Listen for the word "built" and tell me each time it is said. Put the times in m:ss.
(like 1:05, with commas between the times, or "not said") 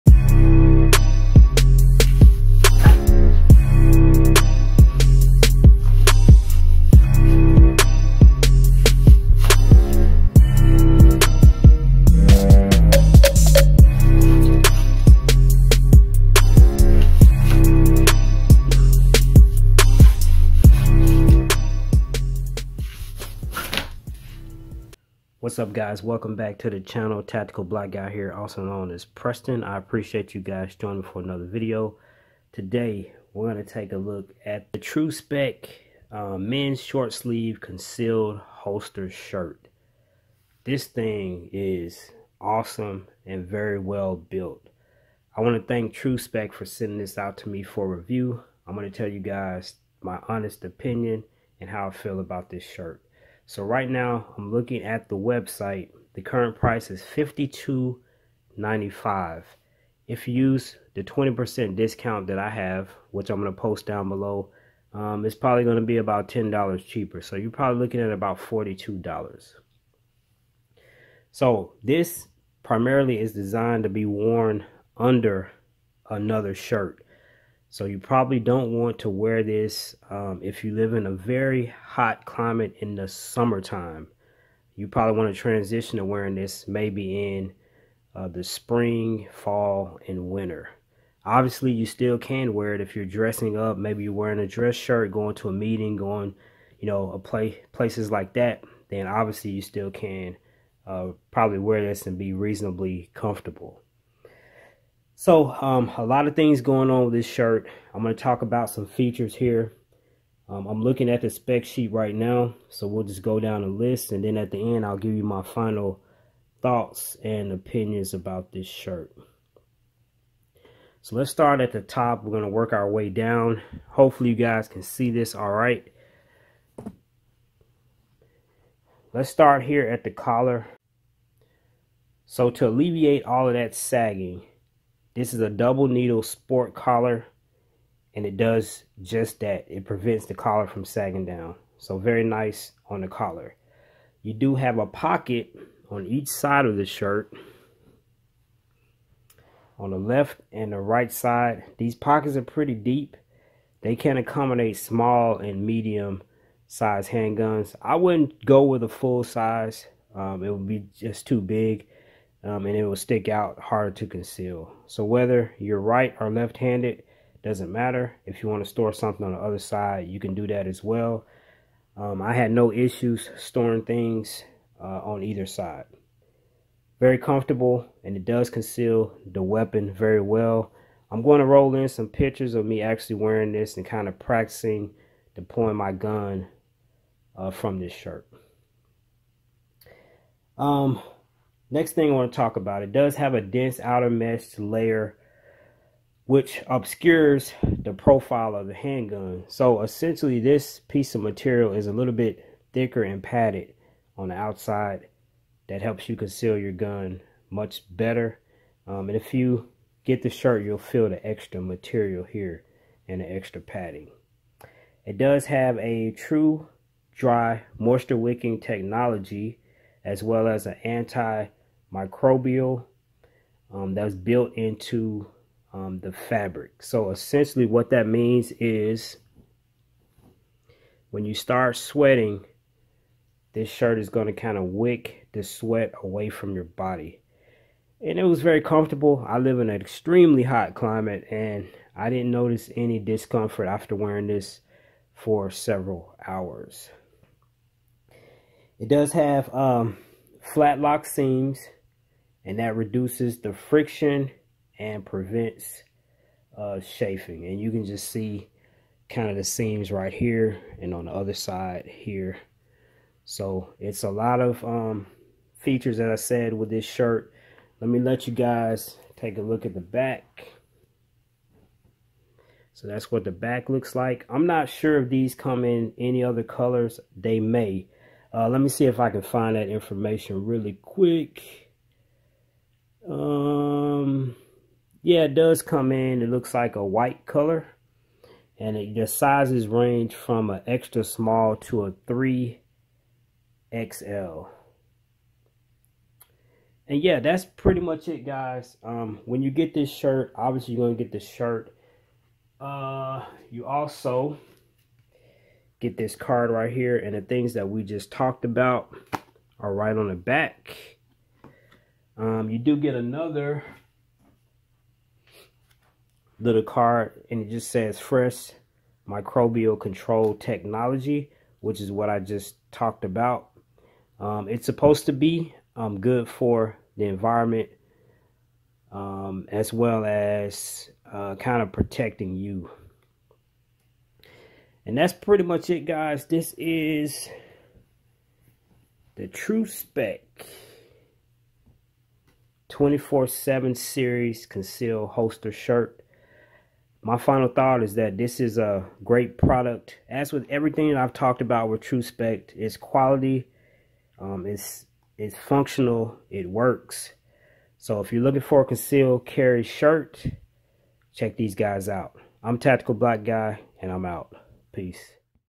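0:44, 3:44.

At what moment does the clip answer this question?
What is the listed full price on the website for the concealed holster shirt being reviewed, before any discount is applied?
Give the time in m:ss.
0:57.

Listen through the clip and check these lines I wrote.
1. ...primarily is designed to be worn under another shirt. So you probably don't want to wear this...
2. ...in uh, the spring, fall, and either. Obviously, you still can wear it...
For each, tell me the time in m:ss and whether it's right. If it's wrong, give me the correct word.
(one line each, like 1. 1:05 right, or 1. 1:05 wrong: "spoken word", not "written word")
1. 1:12 right
2. 1:27 wrong: "winter", not "either".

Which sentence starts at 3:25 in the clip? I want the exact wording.
That helps you conceal your gun much better.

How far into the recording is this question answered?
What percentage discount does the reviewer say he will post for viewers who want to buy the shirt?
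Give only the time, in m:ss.
1:01.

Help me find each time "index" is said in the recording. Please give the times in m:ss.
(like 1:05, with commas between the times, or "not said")
not said.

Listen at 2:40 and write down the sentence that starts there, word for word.
Um, it would be just too big um, and it will stick out hard to conceal.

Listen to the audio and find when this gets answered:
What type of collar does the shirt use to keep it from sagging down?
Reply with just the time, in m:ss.
2:15.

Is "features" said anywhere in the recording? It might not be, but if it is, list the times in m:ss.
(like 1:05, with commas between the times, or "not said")
1:48, 4:25.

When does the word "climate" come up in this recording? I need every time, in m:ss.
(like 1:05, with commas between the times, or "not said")
1:22, 4:00.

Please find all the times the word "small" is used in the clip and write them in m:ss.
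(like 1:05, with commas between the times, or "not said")
2:34, 4:51.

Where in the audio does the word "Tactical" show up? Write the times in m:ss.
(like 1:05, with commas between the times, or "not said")
0:27, 6:02.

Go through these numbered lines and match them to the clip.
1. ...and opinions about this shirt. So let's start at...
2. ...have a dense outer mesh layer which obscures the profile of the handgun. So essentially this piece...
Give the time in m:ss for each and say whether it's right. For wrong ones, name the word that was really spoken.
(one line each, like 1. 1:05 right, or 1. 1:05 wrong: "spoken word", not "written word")
1. 1:57 right
2. 3:13 right.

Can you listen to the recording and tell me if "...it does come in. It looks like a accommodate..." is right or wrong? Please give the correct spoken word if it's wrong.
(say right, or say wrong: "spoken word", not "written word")
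wrong: "white", not "accommodate".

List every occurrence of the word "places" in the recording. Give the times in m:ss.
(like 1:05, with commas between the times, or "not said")
1:37.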